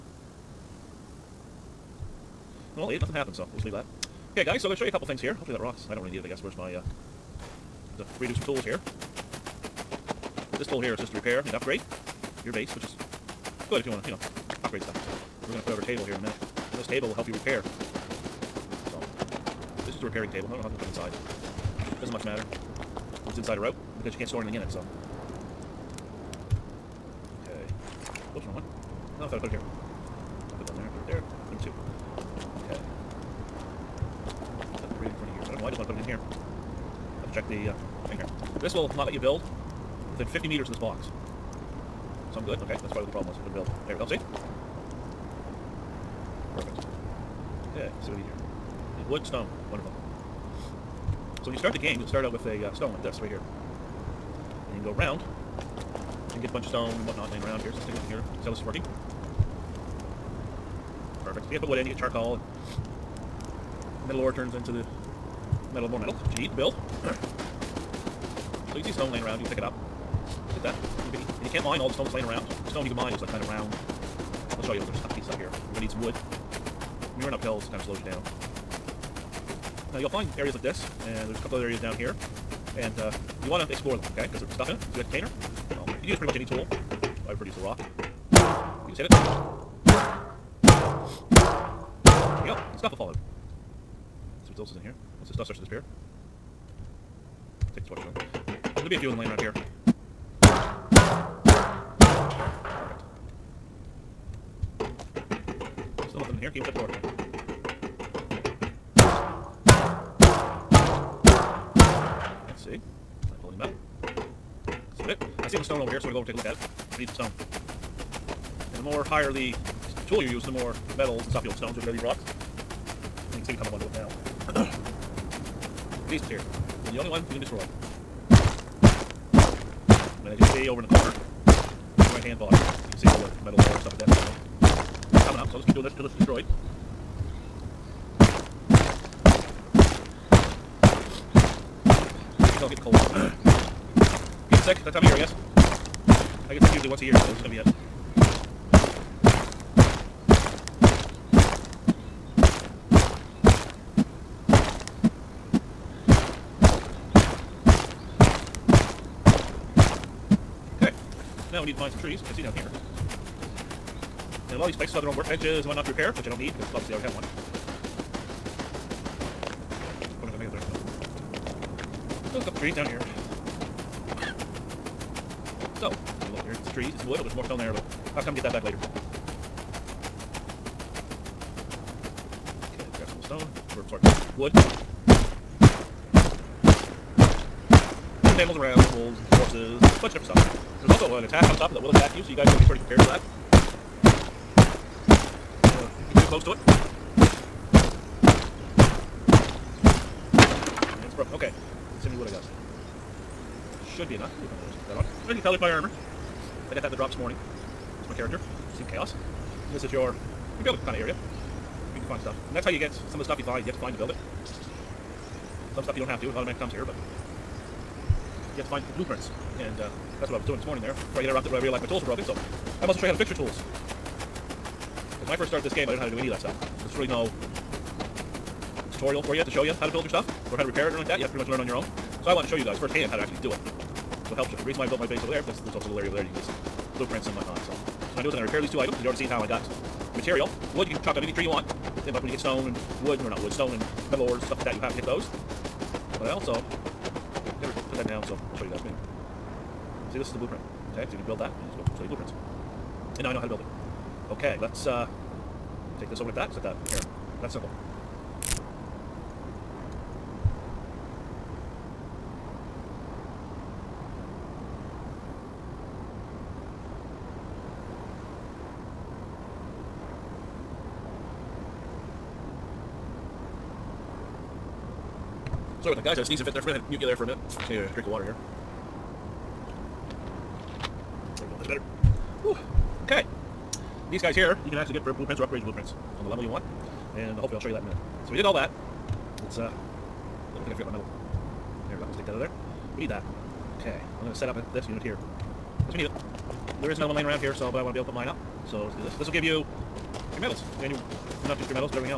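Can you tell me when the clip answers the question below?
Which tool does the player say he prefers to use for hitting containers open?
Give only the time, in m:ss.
1:27.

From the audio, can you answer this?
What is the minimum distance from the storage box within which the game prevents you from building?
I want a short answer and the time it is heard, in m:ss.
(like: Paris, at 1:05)
50 meters, at 0:40.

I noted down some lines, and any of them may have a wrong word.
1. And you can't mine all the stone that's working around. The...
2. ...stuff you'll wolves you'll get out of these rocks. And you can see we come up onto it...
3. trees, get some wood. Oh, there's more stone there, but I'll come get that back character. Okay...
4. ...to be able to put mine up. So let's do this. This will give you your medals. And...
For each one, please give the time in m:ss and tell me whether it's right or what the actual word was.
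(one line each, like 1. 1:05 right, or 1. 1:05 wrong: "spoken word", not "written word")
1. 1:11 wrong: "laying", not "working"
2. 2:01 wrong: "stones", not "wolves"
3. 2:56 wrong: "later", not "character"
4. 4:57 right.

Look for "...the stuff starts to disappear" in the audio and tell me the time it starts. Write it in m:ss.
1:35.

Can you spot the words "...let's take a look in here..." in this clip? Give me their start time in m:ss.
0:57.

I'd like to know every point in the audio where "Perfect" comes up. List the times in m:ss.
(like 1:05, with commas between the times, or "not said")
0:46, 1:01, 1:40.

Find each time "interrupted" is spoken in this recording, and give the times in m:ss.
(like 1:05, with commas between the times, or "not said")
3:41.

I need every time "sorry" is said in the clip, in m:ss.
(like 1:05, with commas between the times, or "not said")
3:03, 4:35.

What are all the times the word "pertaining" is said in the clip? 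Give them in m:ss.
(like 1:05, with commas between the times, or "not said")
not said.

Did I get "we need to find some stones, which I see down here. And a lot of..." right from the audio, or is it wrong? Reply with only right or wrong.
wrong.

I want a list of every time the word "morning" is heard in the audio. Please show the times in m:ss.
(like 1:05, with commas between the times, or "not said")
3:27, 3:40.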